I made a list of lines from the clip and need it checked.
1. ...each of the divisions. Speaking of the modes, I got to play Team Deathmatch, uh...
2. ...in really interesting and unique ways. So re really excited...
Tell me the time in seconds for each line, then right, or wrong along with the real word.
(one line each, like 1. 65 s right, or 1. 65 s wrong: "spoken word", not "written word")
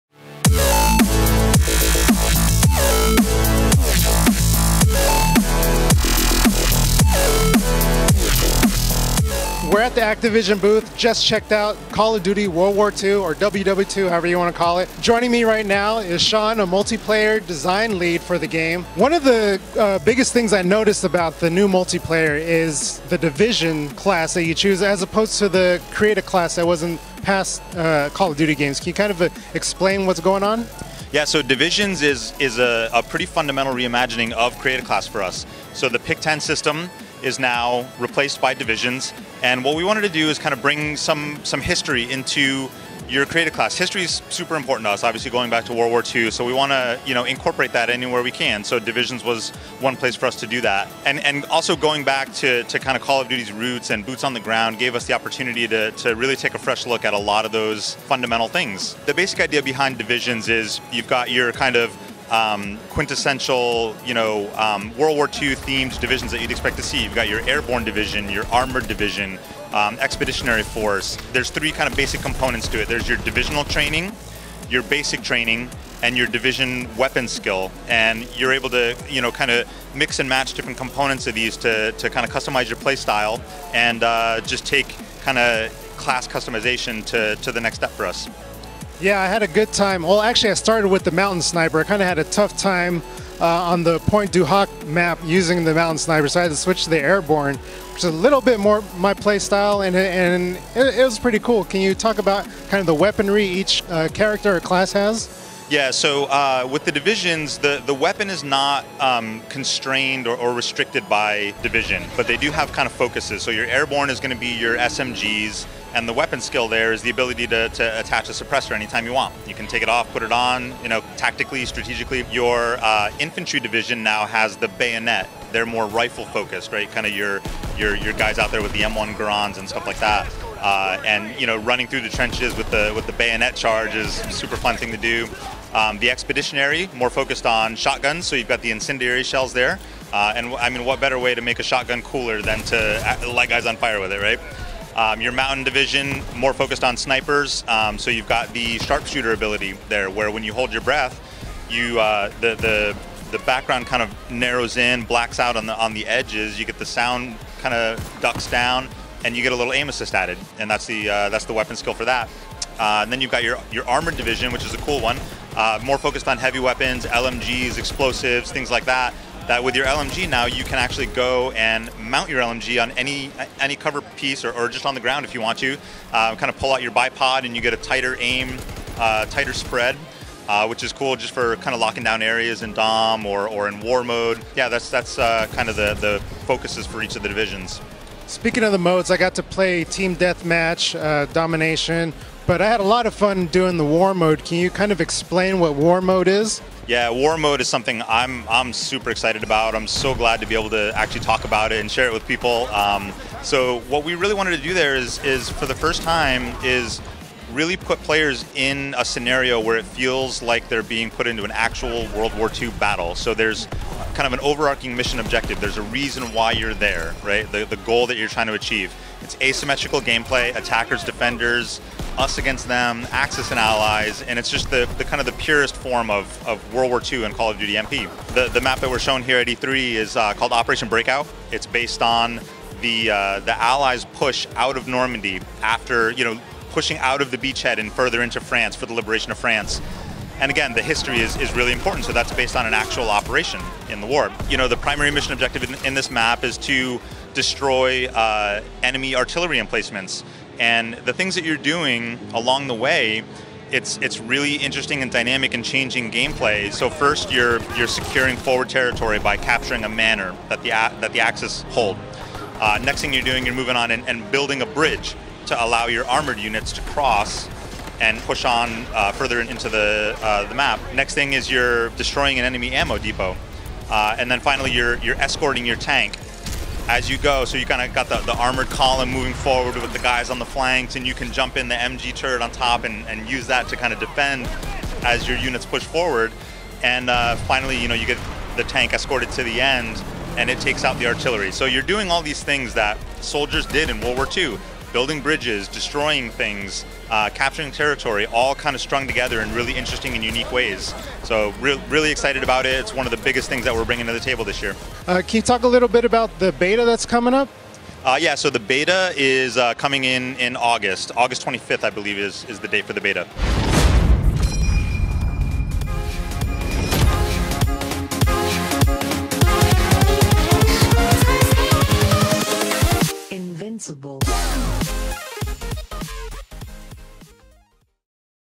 1. 187 s right
2. 299 s right.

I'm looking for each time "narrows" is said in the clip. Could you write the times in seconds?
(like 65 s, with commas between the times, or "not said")
154 s.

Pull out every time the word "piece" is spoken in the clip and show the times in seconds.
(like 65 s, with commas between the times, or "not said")
174 s.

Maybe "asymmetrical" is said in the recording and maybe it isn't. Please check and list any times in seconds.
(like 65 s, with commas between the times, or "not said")
219 s.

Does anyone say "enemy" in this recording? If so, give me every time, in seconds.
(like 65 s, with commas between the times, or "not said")
248 s, 272 s.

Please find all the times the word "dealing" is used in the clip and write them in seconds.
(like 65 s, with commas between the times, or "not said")
not said.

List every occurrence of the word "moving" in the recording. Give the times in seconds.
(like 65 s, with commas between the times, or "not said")
263 s, 279 s.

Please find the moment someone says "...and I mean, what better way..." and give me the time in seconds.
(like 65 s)
140 s.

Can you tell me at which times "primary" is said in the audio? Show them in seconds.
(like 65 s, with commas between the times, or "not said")
244 s.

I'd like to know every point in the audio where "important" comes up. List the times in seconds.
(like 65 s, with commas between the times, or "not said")
44 s, 241 s.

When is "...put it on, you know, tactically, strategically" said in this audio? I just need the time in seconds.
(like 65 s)
120 s.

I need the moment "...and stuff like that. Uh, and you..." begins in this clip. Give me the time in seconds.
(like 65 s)
129 s.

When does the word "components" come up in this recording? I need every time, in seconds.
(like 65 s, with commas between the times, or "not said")
72 s, 80 s.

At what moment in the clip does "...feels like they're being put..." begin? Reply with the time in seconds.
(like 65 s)
209 s.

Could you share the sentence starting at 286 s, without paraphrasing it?
And uh, finally, you know, you get the tank escorted to the end, and it takes out the artillery.